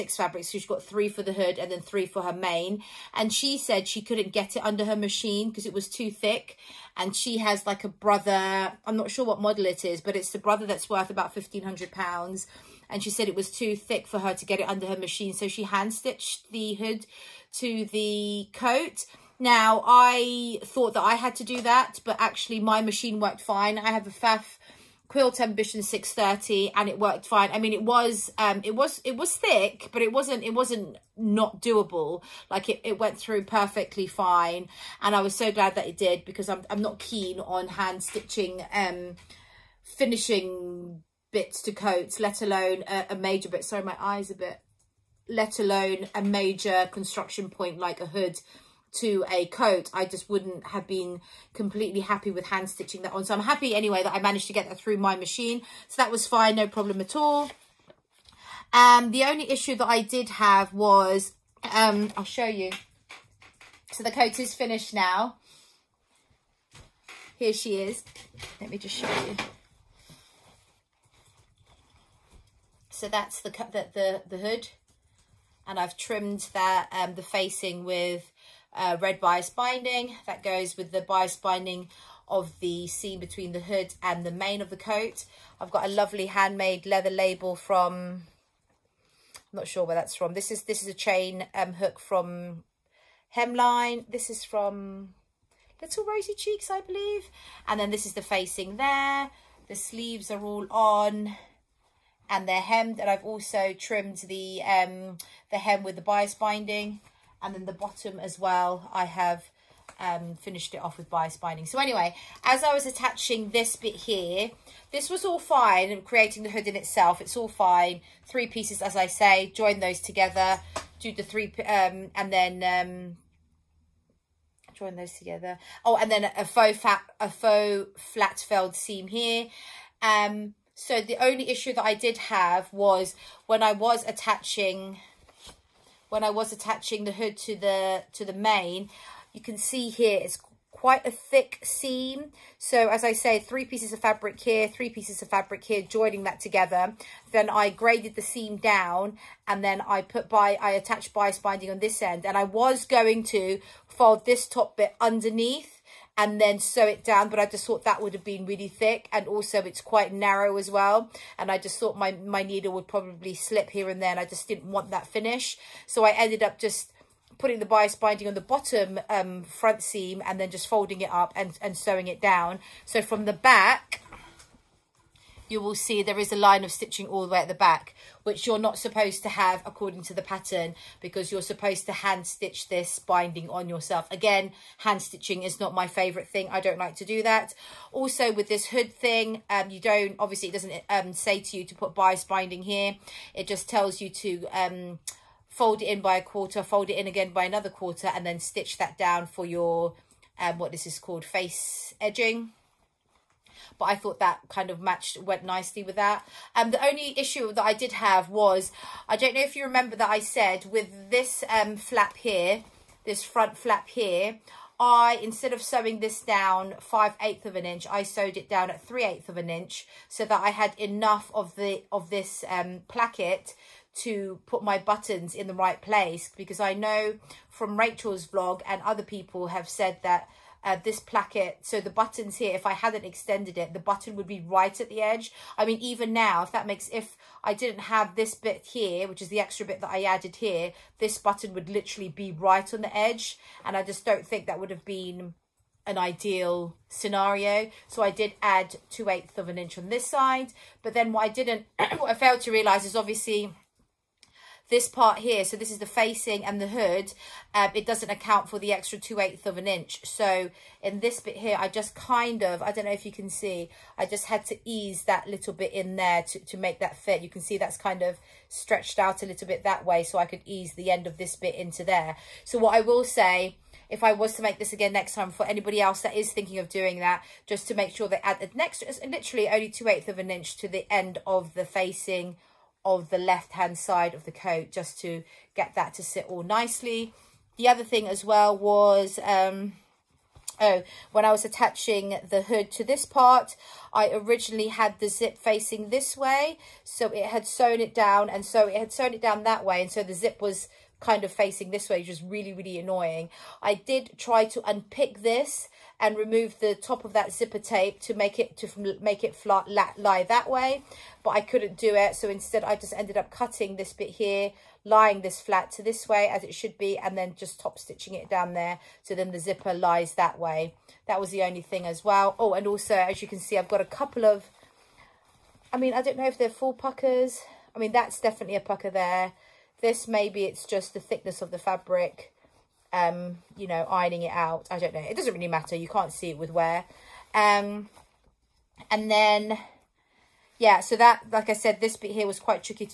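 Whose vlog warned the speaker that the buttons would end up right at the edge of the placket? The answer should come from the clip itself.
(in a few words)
Rachel.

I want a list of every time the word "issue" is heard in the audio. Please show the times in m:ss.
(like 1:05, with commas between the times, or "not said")
0:59, 2:11, 3:27.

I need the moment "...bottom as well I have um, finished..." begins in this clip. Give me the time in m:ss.
1:47.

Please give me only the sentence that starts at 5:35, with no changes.
You can't see it with wear.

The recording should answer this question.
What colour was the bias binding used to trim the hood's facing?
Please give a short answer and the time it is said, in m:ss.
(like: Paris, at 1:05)
Red, at 1:19.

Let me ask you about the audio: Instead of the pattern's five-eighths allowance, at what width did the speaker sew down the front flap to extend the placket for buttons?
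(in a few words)
3/8 inch.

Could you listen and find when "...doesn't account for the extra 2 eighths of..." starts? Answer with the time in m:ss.
4:17.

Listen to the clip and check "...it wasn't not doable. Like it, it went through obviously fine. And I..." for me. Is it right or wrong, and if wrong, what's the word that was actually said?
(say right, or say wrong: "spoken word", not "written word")
wrong: "perfectly", not "obviously".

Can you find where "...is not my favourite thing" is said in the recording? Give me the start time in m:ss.
3:05.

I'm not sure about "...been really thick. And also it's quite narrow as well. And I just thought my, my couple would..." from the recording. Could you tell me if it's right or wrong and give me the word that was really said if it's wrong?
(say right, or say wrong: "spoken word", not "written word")
wrong: "needle", not "couple".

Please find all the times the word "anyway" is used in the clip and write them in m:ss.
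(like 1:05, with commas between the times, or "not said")
0:53, 1:51.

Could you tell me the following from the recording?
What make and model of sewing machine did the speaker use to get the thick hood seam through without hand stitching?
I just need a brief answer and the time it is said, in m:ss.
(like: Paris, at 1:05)
Pfaff Quilt Ambition 630, at 0:24.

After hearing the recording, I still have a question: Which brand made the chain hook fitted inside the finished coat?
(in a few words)
Hemline.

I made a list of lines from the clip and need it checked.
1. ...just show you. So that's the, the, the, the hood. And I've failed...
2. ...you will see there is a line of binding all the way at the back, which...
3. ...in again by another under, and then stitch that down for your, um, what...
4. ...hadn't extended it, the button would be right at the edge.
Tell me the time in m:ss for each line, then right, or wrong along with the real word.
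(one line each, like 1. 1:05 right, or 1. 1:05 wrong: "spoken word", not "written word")
1. 1:08 wrong: "trimmed", not "failed"
2. 2:55 wrong: "stitching", not "binding"
3. 3:16 wrong: "quarter", not "under"
4. 3:52 right.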